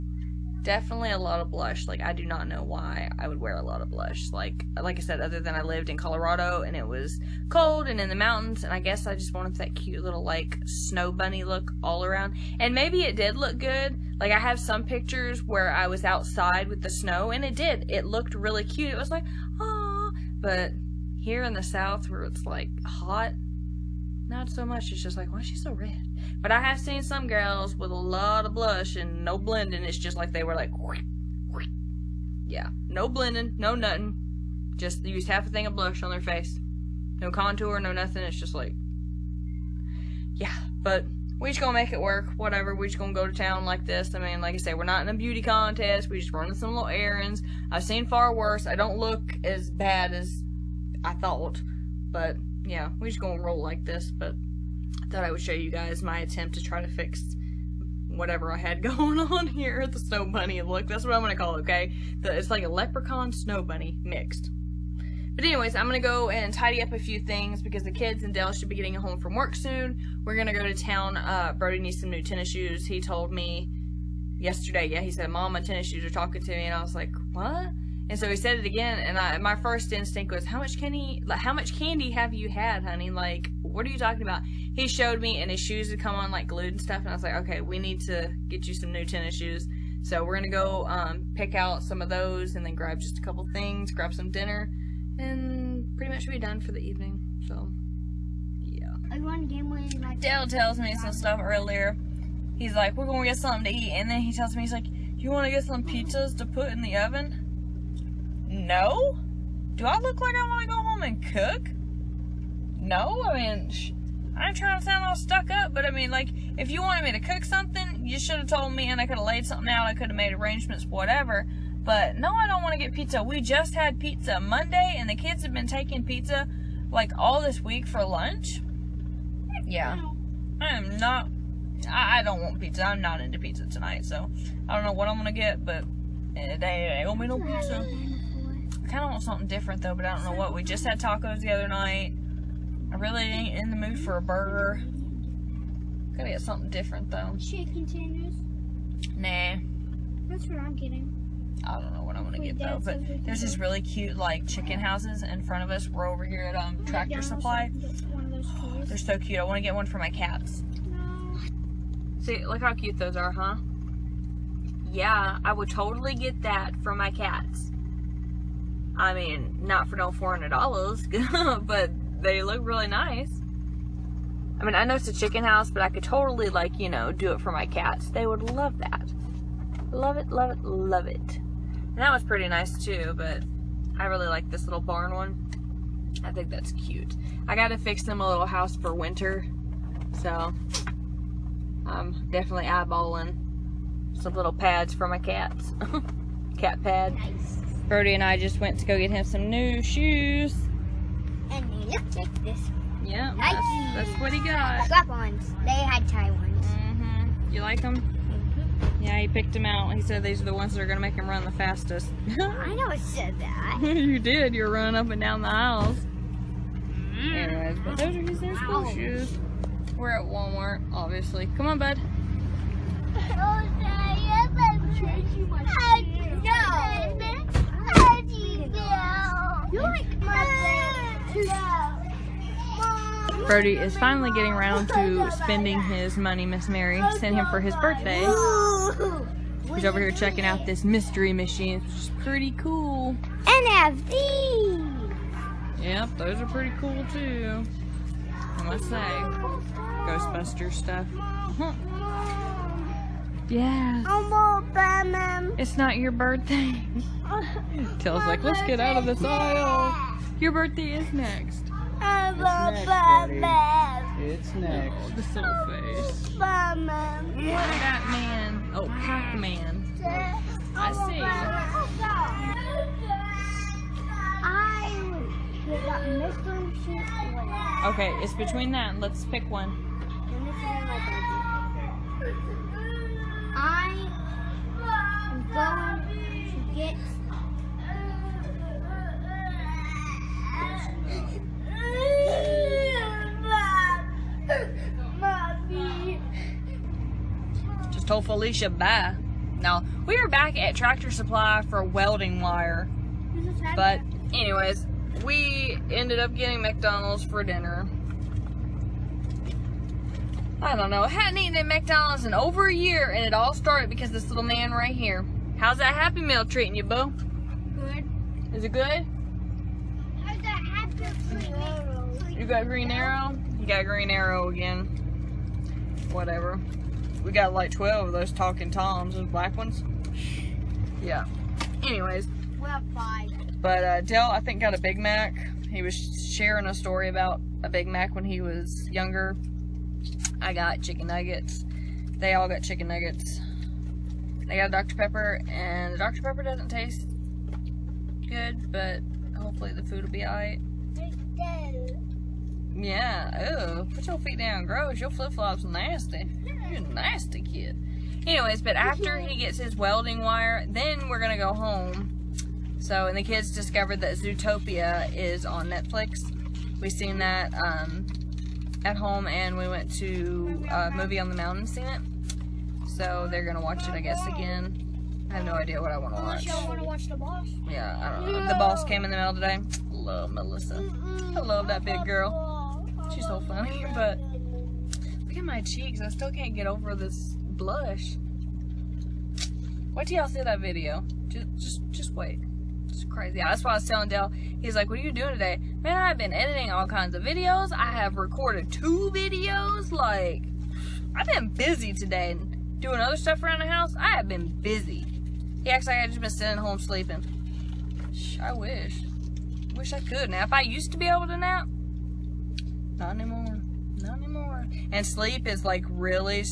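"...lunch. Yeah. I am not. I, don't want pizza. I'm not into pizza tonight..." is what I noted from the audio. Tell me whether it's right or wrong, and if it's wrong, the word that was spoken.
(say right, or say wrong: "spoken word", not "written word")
right.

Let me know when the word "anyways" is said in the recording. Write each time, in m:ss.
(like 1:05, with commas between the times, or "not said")
1:05, 3:37, 5:04, 5:31, 5:58.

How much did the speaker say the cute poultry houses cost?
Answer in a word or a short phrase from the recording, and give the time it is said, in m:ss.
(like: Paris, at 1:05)
$400, at 2:50.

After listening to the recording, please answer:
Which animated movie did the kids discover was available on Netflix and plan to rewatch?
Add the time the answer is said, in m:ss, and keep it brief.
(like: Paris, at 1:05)
Zootopia, at 6:04.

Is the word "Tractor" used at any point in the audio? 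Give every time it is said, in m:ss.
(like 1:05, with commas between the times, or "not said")
2:36, 5:00.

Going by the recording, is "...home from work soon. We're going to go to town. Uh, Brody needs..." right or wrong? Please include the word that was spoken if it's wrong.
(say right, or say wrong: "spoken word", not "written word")
right.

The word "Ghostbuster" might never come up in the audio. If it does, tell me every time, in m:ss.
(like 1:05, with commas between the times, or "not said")
4:10.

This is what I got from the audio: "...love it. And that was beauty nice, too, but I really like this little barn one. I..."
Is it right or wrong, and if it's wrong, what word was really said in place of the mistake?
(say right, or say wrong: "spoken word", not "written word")
wrong: "pretty", not "beauty".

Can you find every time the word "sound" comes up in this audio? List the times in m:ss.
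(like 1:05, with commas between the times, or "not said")
1:54.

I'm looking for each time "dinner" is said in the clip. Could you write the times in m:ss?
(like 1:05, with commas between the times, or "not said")
1:34, 5:07.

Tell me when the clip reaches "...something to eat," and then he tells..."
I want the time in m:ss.
1:43.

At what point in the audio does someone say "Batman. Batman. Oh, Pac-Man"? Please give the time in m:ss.
4:26.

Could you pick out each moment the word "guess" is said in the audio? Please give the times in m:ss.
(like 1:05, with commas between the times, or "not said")
0:08, 6:13.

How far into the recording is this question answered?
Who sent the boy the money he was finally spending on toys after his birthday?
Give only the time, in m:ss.
3:56.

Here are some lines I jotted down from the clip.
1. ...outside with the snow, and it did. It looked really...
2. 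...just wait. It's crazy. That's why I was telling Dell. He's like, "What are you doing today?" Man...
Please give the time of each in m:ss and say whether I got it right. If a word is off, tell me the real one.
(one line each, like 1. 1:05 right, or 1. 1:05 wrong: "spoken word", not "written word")
1. 0:16 right
2. 6:31 right.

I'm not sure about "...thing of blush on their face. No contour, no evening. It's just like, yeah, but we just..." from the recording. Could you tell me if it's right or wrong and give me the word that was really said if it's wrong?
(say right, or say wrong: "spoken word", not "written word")
wrong: "nothing", not "evening".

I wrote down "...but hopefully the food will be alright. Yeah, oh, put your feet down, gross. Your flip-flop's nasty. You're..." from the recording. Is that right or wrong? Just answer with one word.
right.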